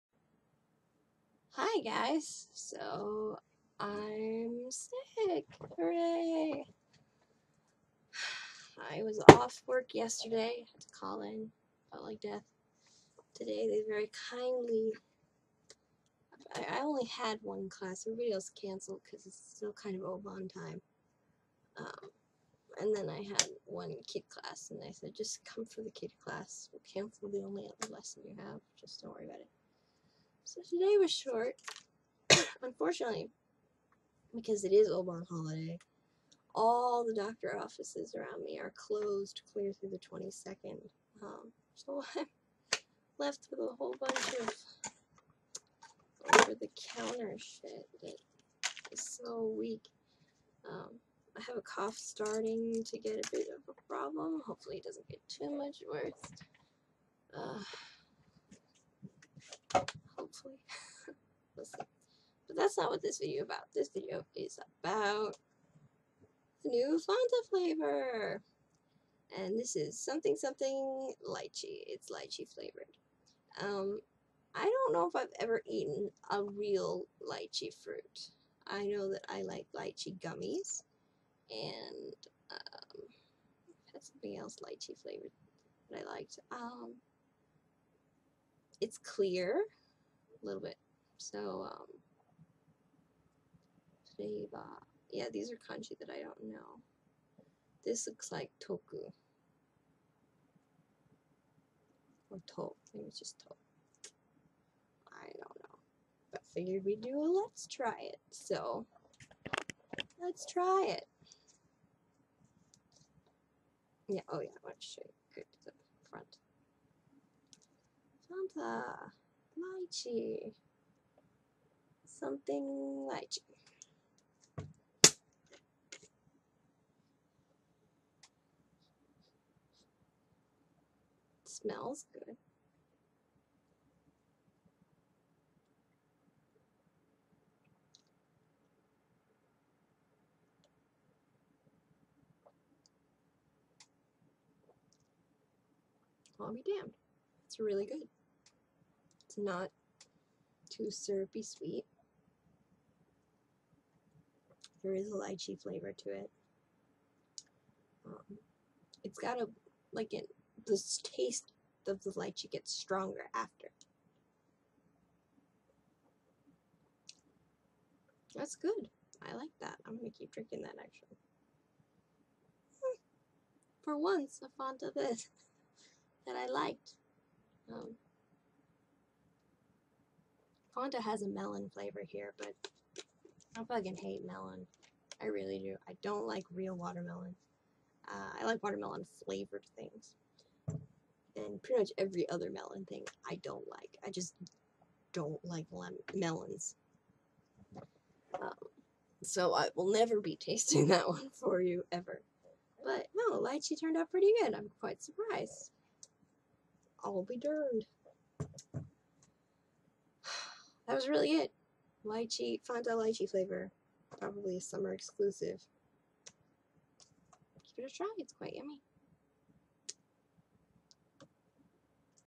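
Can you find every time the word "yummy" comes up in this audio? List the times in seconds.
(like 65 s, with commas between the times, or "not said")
218 s.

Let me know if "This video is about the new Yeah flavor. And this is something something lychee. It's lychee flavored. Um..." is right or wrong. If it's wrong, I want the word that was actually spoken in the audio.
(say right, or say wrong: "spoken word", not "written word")
wrong: "Fanta", not "Yeah".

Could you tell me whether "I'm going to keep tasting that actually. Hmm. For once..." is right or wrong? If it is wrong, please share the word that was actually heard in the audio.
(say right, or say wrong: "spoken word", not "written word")
wrong: "drinking", not "tasting".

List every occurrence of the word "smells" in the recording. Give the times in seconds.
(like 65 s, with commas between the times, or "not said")
131 s.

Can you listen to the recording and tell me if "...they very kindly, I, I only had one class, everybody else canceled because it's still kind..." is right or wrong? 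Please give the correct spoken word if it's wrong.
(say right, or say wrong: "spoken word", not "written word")
right.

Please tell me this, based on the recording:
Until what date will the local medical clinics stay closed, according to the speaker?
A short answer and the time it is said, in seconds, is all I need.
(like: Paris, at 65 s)
the 22nd, at 39 s.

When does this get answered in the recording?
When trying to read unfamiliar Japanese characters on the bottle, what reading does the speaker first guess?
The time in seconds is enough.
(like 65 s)
98 s.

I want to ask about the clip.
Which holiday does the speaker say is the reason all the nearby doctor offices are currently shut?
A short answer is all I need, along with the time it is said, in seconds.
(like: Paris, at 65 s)
Obon, at 34 s.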